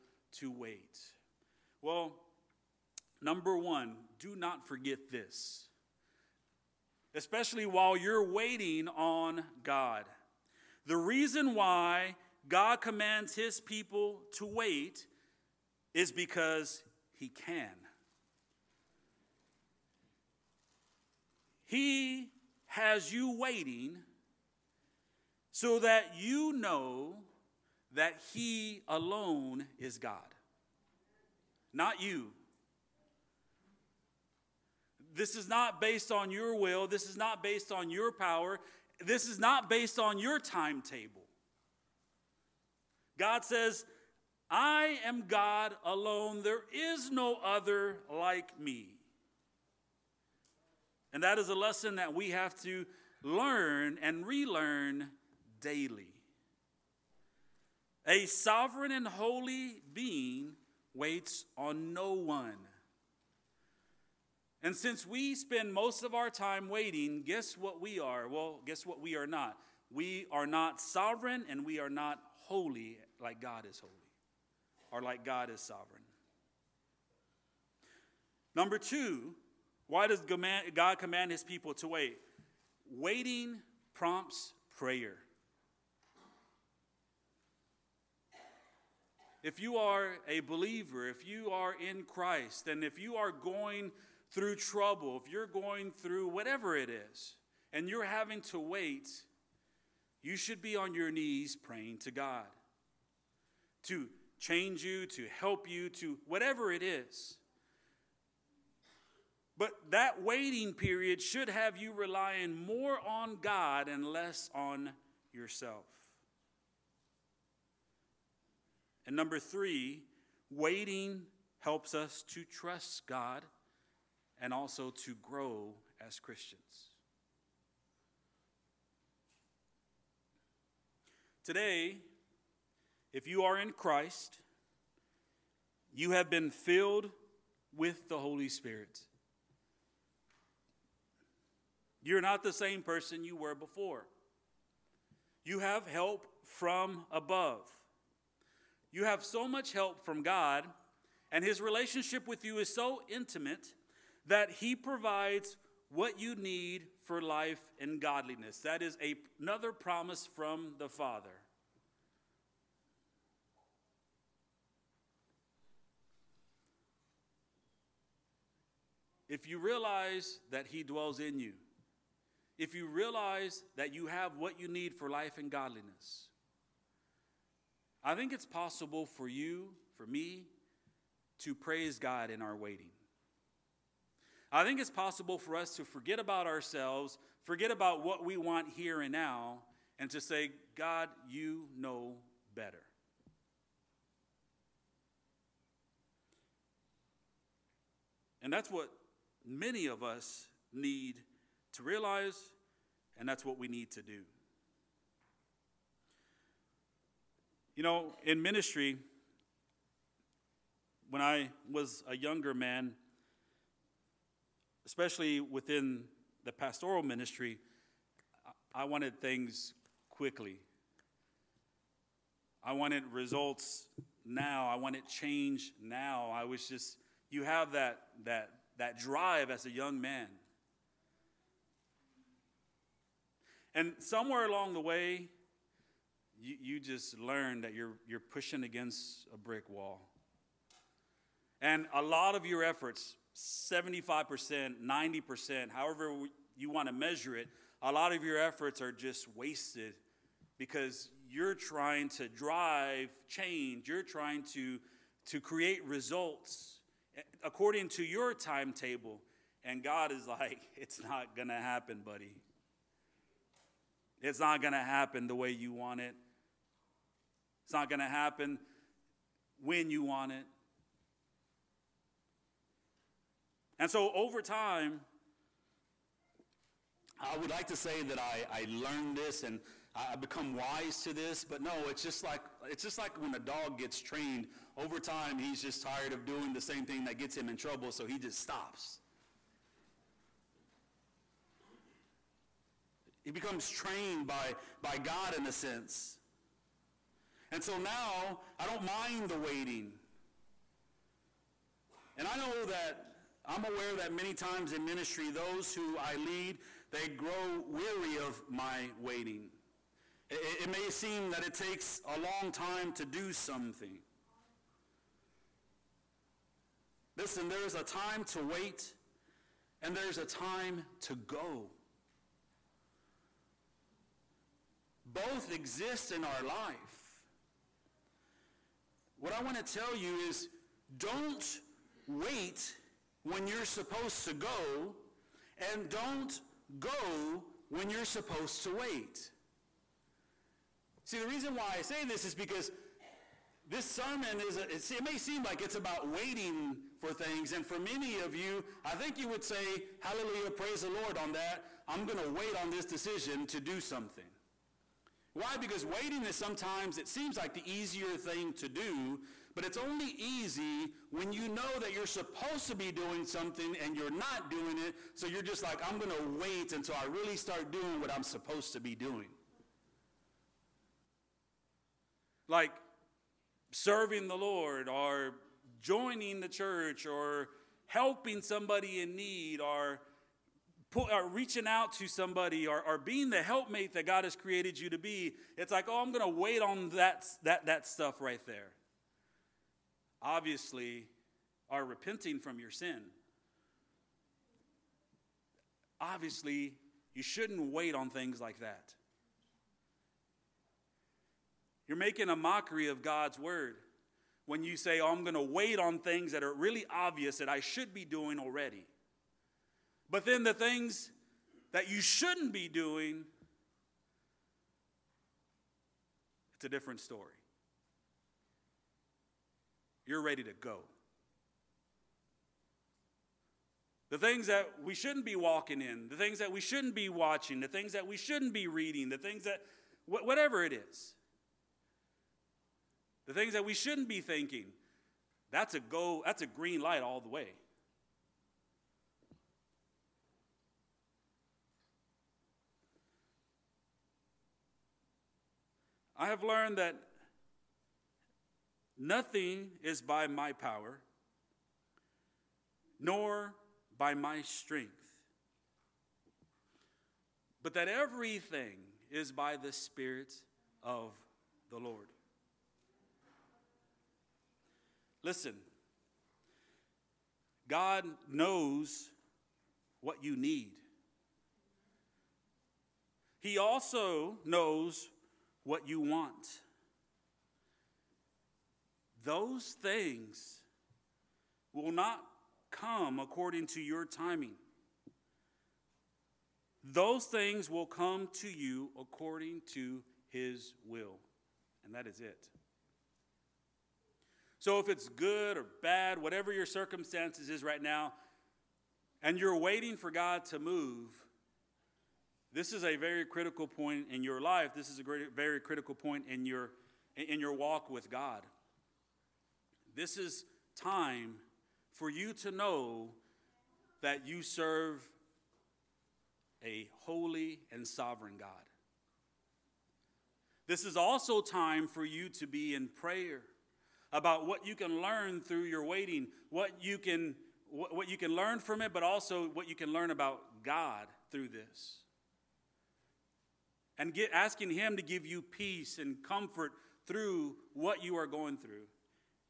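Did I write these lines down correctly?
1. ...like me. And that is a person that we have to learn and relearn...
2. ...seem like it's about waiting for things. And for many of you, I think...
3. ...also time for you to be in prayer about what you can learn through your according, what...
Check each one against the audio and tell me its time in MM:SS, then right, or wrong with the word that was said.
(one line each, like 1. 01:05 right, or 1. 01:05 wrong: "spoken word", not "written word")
1. 00:48 wrong: "lesson", not "person"
2. 05:45 right
3. 08:40 wrong: "waiting", not "according".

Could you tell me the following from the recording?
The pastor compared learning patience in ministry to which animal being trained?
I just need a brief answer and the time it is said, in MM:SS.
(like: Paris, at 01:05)
A dog, at 04:43.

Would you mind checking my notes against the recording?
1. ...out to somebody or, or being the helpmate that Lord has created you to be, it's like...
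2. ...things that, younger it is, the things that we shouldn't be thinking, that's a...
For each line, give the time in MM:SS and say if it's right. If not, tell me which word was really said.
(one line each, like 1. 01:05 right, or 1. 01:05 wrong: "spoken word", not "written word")
1. 06:21 wrong: "God", not "Lord"
2. 07:09 wrong: "whatever", not "younger".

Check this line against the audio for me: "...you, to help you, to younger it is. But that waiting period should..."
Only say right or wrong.
wrong.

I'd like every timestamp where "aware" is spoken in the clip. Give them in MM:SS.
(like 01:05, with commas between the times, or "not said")
05:03.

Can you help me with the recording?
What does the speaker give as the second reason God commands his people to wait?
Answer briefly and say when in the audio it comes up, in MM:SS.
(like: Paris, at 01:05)
Waiting prompts prayer, at 01:22.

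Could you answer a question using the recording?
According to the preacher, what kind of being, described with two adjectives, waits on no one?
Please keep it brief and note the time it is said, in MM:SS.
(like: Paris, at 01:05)
Sovereign and holy, at 00:58.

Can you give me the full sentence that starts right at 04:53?
He becomes trained by, by God in a sense.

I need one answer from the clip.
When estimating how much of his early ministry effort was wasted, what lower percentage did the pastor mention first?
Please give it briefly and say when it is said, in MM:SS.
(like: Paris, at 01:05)
75%, at 04:03.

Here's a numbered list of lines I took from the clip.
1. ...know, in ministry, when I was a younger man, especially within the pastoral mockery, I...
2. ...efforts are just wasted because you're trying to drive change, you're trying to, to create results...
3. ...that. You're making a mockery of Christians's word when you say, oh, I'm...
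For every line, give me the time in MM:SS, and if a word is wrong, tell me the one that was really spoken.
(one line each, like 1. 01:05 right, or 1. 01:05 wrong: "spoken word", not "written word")
1. 03:27 wrong: "ministry", not "mockery"
2. 04:08 right
3. 06:38 wrong: "God", not "Christians".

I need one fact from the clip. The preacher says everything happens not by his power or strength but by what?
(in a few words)
The Spirit of the Lord.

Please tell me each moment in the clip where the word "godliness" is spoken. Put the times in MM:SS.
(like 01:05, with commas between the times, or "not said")
02:37, 02:55.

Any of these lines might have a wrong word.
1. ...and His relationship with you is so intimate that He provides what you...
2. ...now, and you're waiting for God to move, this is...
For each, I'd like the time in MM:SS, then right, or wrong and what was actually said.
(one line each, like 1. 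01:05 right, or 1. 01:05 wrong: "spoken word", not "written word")
1. 02:31 right
2. 08:17 right.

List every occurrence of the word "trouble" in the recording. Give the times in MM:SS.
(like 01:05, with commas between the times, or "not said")
01:34, 04:47.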